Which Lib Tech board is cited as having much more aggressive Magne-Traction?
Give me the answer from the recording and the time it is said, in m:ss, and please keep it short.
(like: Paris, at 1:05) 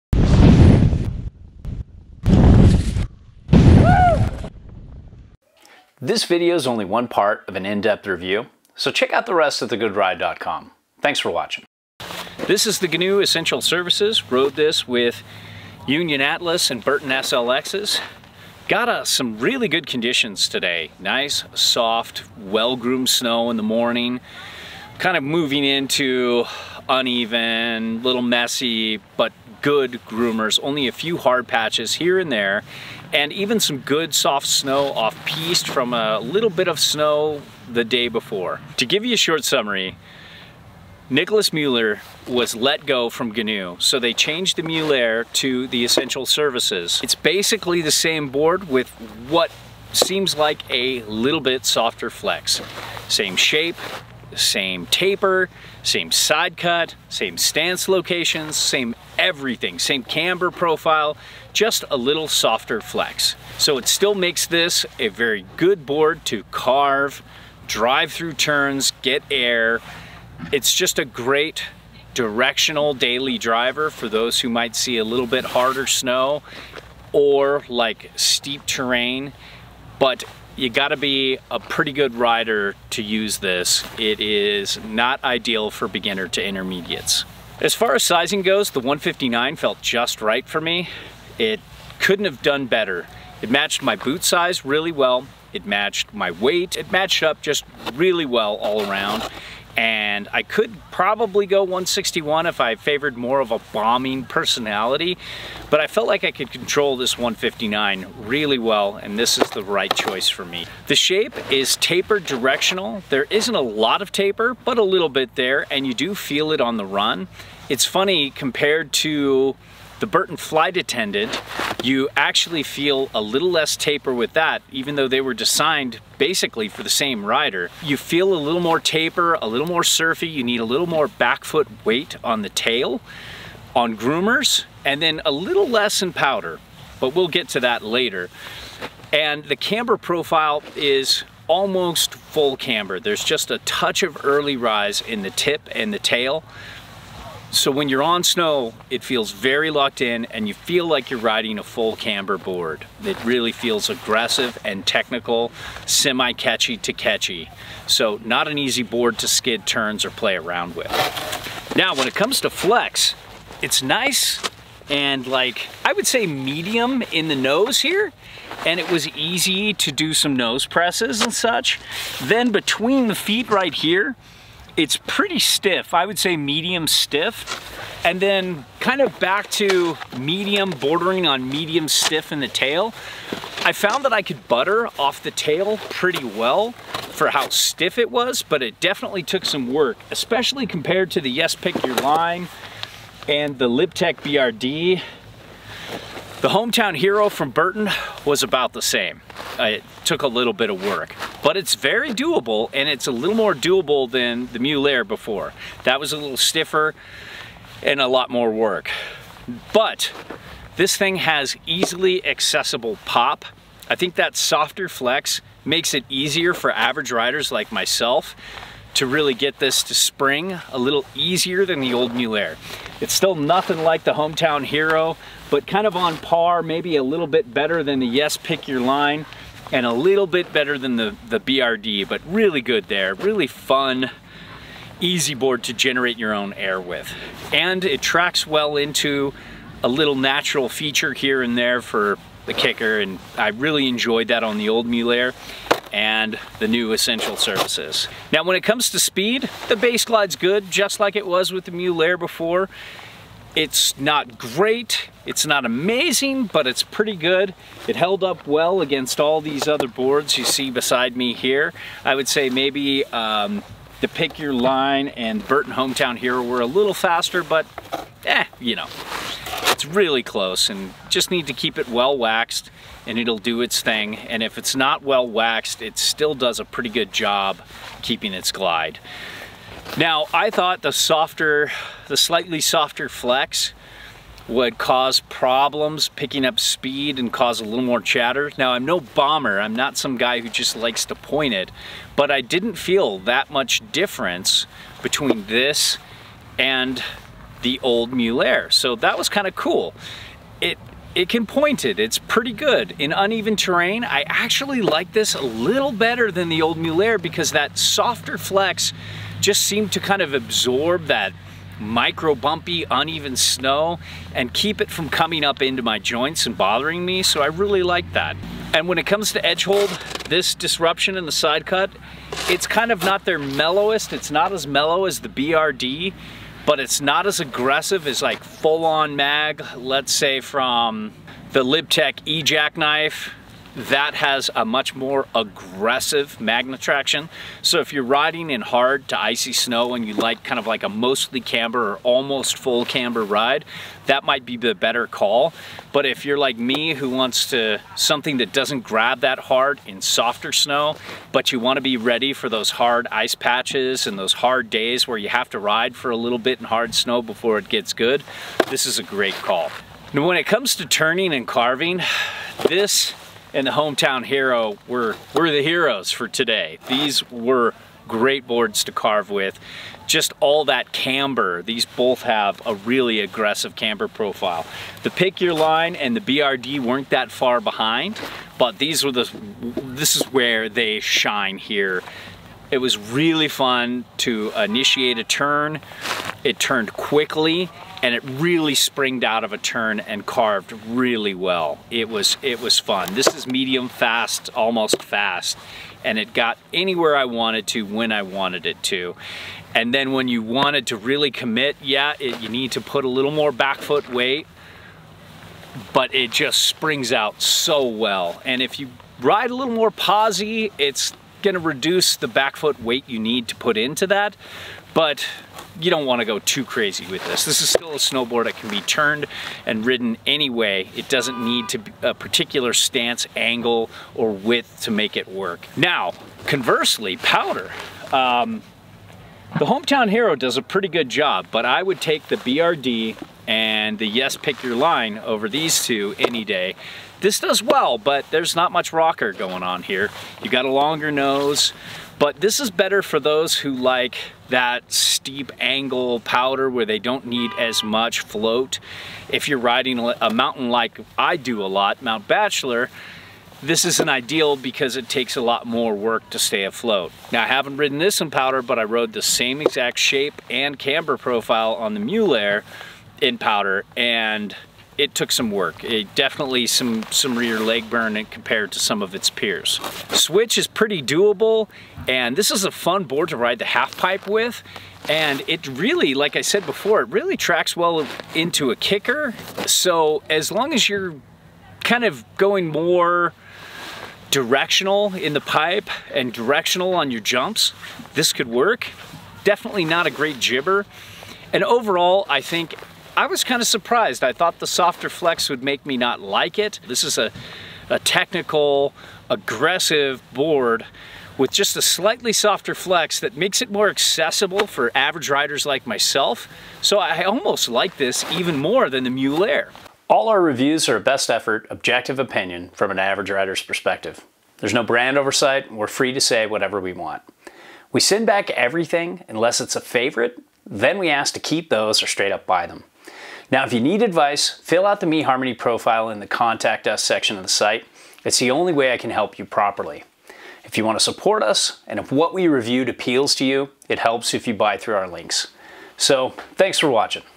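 E Jack Knife, at 5:32.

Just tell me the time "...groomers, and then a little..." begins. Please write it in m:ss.
2:13.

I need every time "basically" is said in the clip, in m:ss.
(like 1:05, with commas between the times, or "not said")
0:47, 2:06.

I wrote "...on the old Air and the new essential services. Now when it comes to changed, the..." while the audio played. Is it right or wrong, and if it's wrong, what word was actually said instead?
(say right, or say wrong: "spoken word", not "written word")
wrong: "speed", not "changed".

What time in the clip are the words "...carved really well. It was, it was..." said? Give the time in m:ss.
6:30.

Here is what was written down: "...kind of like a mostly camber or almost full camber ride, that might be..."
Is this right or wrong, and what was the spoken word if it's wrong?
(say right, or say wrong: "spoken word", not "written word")
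right.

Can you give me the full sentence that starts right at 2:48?
And it was easy to do some nose presses and such.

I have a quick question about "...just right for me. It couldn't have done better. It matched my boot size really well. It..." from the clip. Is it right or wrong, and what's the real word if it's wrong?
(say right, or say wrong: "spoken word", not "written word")
right.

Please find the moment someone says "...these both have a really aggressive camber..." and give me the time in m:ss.
6:11.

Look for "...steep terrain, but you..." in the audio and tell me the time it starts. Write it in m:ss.
1:18.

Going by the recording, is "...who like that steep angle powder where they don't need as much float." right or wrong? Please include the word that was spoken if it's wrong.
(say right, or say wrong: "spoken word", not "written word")
right.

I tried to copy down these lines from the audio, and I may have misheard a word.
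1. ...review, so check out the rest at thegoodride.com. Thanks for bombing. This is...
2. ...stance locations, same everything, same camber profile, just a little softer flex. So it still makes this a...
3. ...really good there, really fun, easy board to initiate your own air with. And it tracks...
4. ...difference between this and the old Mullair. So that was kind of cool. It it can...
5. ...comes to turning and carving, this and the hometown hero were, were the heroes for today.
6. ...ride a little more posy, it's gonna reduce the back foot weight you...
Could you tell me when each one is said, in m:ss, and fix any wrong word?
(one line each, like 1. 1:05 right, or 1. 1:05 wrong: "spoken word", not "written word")
1. 0:08 wrong: "watching", not "bombing"
2. 0:57 right
3. 3:52 wrong: "generate", not "initiate"
4. 4:53 right
5. 6:00 right
6. 6:49 right.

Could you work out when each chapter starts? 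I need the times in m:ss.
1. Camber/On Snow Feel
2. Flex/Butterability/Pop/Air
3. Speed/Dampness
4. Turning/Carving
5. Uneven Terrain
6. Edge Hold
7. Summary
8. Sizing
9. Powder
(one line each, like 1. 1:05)
1. 1:50
2. 2:40
3. 4:07
4. 6:00
5. 5:02
6. 5:17
7. 0:38
8. 1:27
9. 7:05.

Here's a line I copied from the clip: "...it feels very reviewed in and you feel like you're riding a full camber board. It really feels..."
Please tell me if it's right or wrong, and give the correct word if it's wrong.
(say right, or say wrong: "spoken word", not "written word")
wrong: "locked", not "reviewed".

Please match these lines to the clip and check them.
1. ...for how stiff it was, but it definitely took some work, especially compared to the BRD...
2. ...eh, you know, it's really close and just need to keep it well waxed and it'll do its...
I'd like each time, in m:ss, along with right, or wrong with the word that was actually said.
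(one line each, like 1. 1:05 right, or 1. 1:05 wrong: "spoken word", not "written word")
1. 3:07 wrong: "Yes", not "BRD"
2. 4:28 right.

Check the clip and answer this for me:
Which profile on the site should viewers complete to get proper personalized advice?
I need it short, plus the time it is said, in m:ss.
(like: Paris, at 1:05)
MeHarmony, at 8:45.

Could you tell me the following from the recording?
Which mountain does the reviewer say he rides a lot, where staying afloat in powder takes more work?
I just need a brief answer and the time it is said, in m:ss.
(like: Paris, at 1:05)
Mount Bachelor, at 7:32.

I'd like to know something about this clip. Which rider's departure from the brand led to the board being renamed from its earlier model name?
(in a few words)
Nicolas Müller.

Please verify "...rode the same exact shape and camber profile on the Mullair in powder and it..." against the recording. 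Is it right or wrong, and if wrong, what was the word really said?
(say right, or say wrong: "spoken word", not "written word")
right.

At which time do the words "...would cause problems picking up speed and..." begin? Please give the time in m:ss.
4:44.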